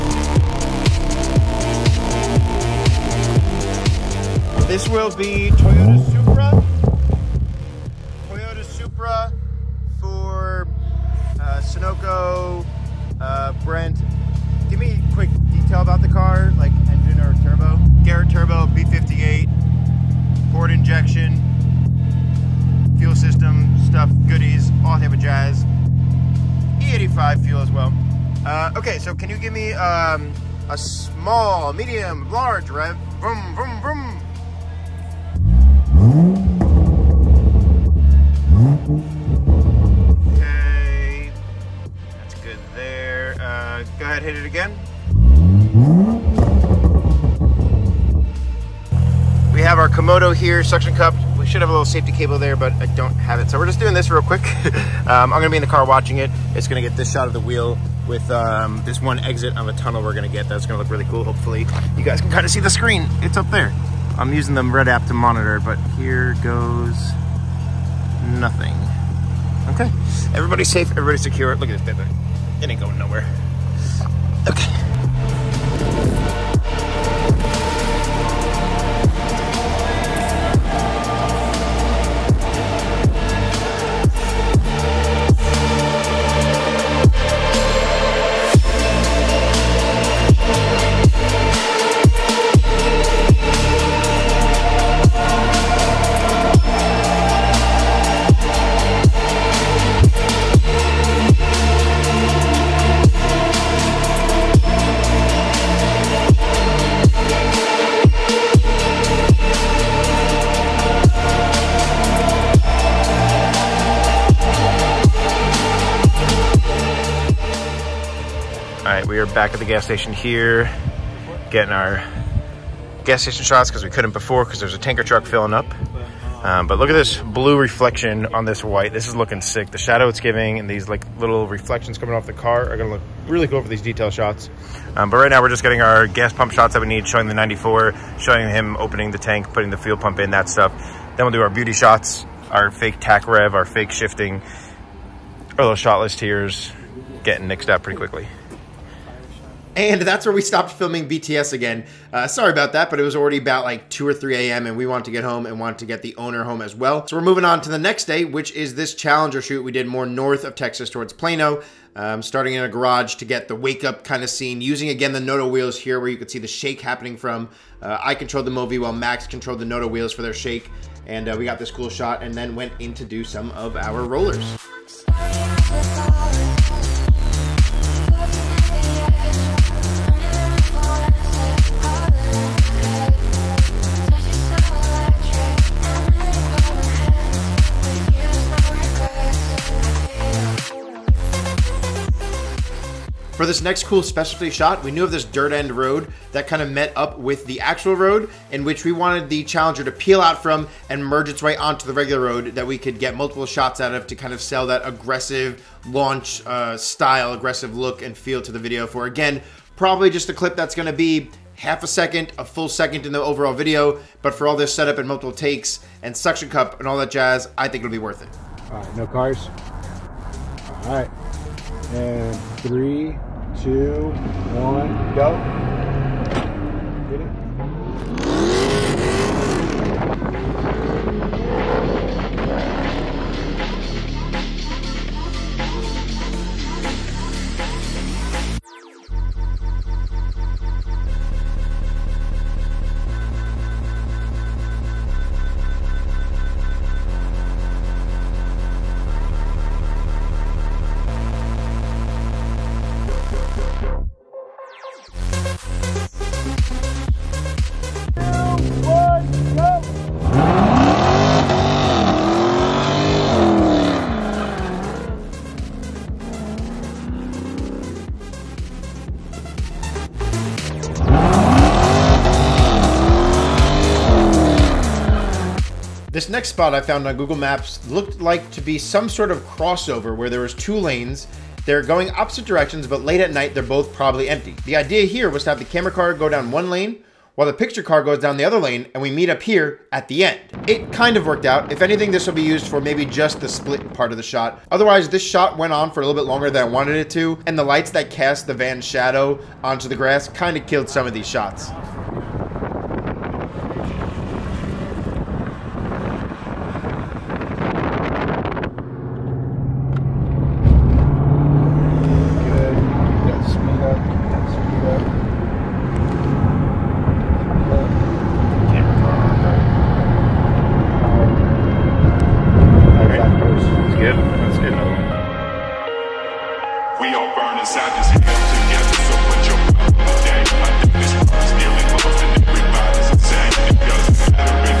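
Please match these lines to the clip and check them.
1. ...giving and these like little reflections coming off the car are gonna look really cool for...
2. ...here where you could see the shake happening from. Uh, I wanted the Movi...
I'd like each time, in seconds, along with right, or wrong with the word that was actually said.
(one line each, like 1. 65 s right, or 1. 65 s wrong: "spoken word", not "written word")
1. 130 s right
2. 165 s wrong: "controlled", not "wanted".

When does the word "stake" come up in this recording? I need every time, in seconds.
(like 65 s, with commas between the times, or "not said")
not said.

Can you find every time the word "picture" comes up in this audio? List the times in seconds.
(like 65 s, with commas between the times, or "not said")
287 s.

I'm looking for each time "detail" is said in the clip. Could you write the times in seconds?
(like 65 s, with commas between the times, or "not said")
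15 s, 133 s.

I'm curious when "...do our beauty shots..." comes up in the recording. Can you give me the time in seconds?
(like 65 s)
141 s.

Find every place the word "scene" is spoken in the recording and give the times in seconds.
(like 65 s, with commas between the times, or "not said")
164 s.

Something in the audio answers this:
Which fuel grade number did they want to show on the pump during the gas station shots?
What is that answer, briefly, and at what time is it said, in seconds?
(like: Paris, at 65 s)
94, at 137 s.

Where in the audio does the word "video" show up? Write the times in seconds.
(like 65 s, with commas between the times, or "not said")
208 s, 213 s.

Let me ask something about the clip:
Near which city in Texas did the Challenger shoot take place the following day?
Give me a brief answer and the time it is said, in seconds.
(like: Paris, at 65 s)
Plano, at 161 s.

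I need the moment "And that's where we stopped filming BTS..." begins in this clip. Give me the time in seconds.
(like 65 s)
149 s.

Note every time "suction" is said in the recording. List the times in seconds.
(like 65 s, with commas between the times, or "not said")
50 s, 216 s.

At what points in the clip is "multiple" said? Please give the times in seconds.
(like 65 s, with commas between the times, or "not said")
203 s, 215 s.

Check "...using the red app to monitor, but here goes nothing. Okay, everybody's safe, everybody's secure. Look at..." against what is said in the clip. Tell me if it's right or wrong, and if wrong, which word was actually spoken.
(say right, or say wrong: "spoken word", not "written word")
right.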